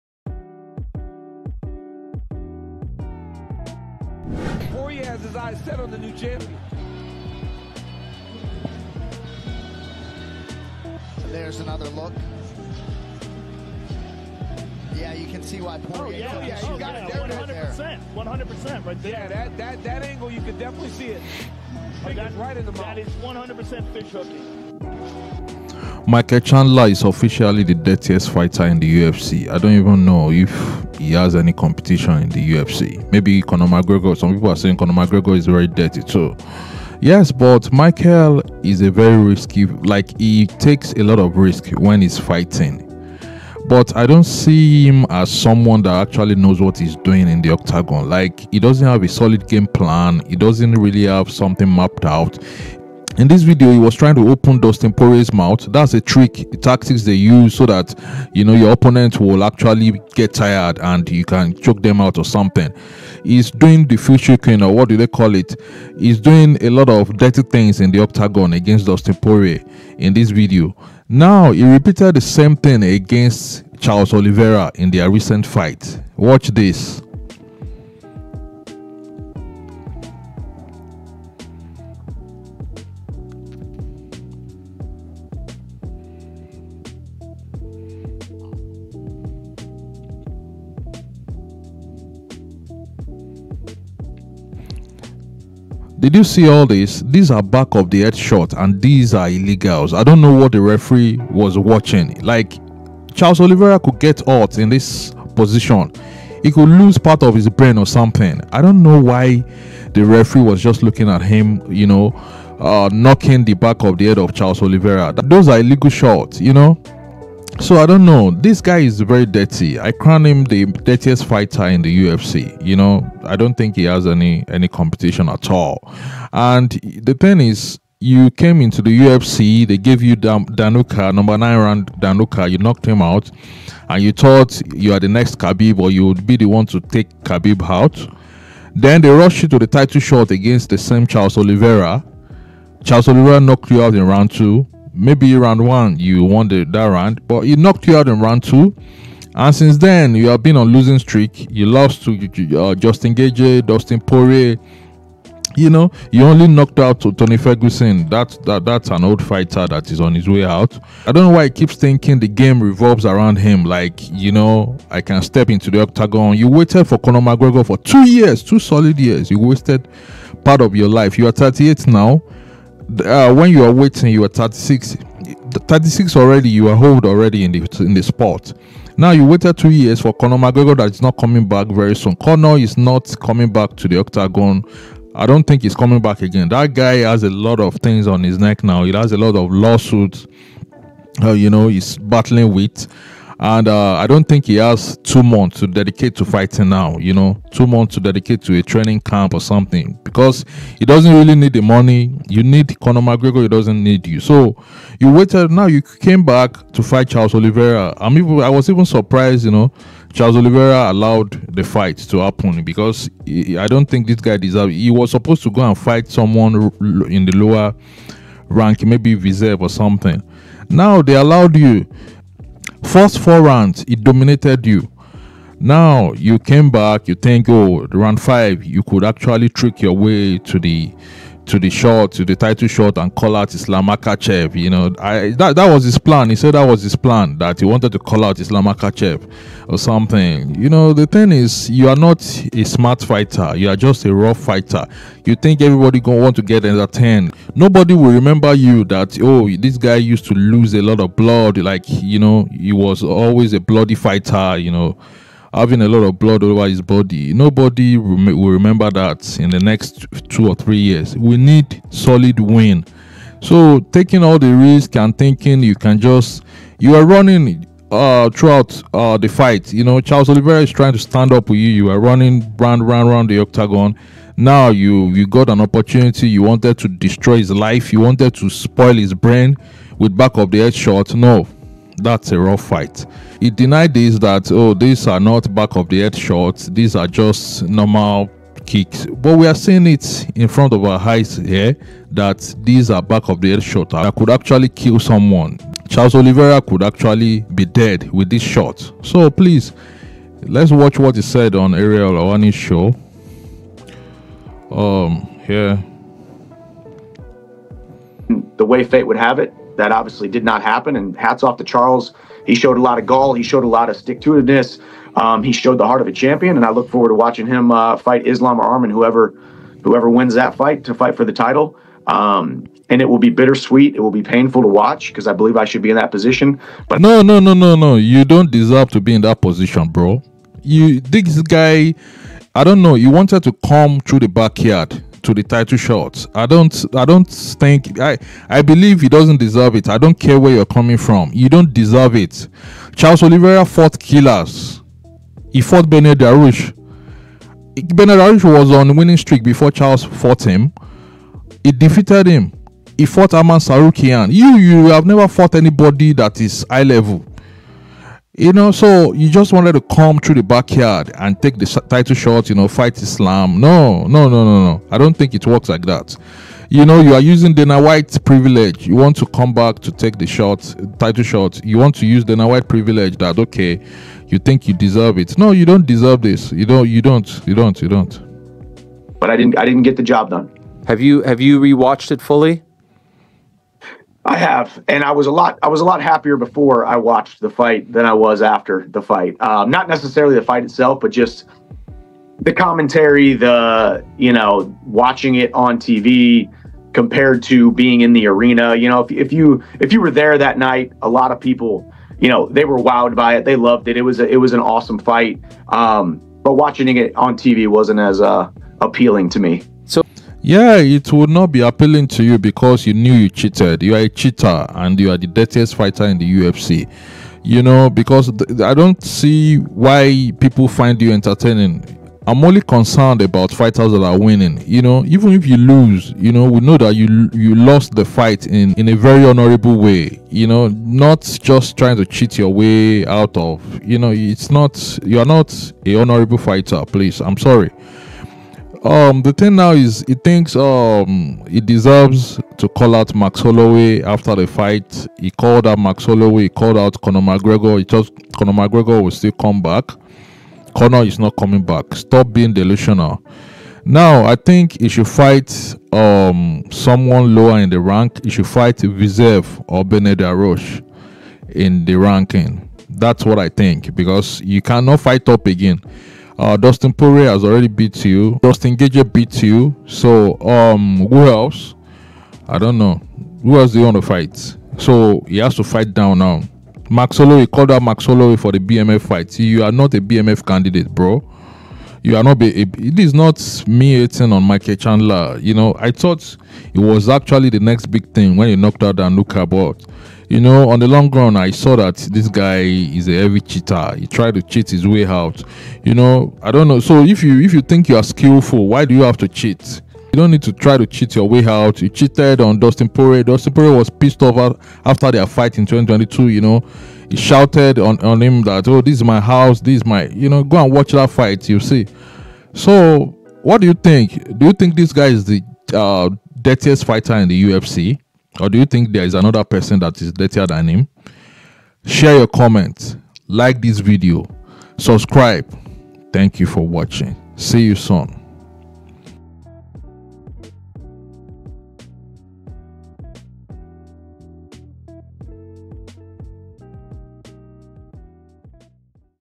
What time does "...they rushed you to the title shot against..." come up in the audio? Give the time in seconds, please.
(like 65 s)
139 s.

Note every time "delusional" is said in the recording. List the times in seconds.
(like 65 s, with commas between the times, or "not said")
452 s.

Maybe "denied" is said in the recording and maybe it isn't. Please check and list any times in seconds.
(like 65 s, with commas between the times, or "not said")
283 s.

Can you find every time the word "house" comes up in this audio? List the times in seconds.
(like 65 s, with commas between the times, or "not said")
509 s.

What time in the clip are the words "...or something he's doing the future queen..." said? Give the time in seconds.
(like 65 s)
62 s.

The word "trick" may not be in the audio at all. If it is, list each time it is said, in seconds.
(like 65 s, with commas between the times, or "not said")
56 s, 229 s.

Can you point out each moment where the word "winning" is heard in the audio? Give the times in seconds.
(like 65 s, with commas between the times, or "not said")
348 s, 424 s.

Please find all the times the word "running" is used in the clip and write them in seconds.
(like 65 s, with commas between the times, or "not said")
267 s, 271 s.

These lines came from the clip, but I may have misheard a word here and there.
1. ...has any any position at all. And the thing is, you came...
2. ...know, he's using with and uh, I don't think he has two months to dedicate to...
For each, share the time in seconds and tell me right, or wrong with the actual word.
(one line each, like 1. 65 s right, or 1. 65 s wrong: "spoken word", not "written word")
1. 123 s wrong: "competition", not "position"
2. 191 s wrong: "battling", not "using".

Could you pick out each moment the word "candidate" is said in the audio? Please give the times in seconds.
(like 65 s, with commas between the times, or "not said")
480 s.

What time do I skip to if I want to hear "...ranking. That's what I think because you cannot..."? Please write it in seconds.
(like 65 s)
461 s.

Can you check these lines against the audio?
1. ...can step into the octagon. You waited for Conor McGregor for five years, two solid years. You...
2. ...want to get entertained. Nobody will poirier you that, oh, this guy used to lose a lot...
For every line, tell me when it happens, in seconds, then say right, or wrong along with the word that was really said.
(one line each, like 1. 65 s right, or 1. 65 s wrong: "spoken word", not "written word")
1. 165 s wrong: "two", not "five"
2. 246 s wrong: "remember", not "poirier".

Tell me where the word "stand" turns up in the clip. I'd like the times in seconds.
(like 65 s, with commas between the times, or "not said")
270 s.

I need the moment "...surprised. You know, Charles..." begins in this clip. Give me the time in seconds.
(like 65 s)
208 s.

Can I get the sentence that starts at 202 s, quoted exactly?
You need Conor McGregor, he doesn't need you.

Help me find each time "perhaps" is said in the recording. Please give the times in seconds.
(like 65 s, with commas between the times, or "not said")
not said.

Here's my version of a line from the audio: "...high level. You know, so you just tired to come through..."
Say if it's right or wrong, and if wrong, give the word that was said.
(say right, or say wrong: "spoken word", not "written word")
wrong: "wanted", not "tired".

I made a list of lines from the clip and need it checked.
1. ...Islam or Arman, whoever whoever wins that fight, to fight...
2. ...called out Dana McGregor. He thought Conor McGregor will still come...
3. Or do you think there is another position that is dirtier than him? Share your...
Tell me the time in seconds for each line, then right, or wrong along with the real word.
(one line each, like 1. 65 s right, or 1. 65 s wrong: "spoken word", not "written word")
1. 318 s right
2. 446 s wrong: "Conor", not "Dana"
3. 518 s wrong: "person", not "position".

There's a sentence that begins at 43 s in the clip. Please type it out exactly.
But I don't see him as someone that actually knows what he's doing in the octagon.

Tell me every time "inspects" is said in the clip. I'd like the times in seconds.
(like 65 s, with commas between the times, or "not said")
not said.